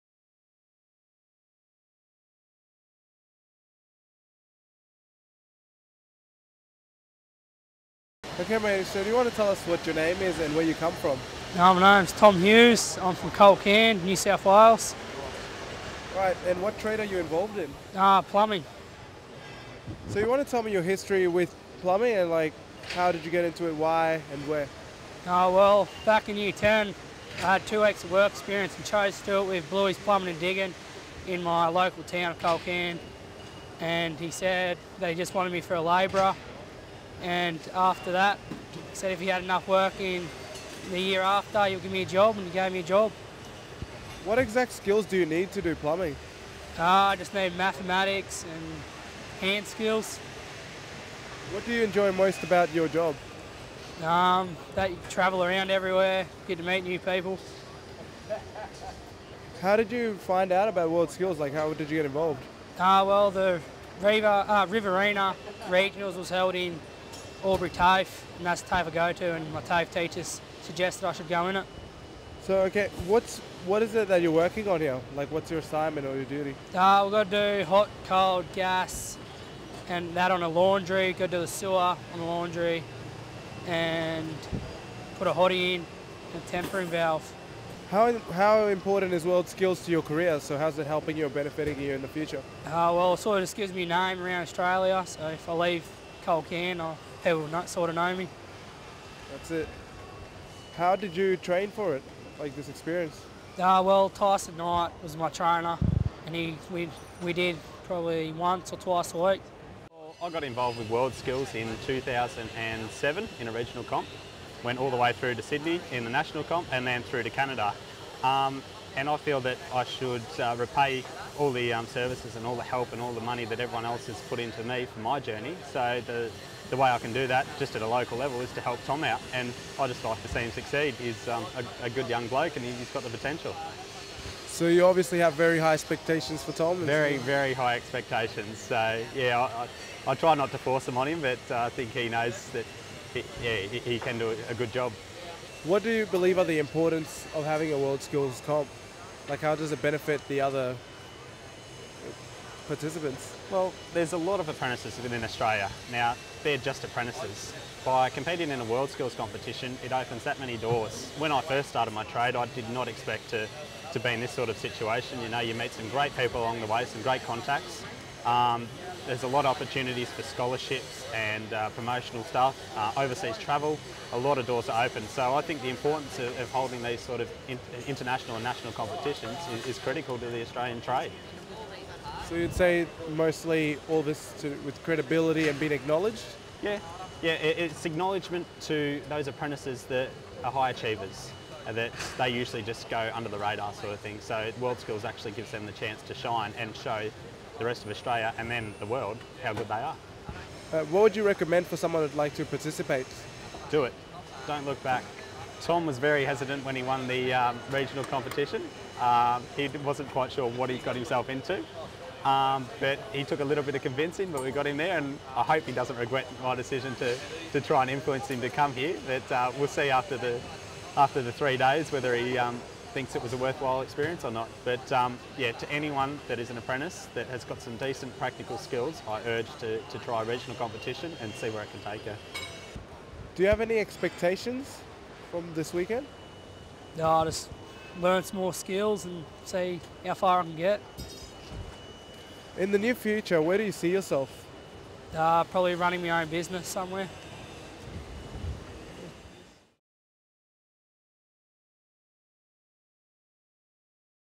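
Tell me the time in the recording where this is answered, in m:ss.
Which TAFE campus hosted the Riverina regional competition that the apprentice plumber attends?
1:07.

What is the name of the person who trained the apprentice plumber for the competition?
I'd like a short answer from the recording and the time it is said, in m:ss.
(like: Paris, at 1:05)
Tyson Knight, at 1:44.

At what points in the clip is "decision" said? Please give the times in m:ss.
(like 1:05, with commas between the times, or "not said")
3:36.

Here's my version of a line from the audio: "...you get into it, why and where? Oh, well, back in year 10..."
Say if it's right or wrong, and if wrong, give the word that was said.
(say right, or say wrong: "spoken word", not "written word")
right.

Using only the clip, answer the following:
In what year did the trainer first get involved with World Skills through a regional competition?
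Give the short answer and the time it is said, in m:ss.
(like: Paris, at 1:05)
2007, at 1:51.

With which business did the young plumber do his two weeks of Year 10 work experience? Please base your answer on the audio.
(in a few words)
Bluey's Plumbing and Digging.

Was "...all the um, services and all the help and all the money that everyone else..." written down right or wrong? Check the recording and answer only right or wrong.
right.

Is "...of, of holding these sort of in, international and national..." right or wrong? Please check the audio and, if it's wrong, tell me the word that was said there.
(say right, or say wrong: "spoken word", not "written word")
right.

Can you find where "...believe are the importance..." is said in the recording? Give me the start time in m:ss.
2:26.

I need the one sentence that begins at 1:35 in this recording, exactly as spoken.
So if I leave Culcairn, I'll they will not sort of know me.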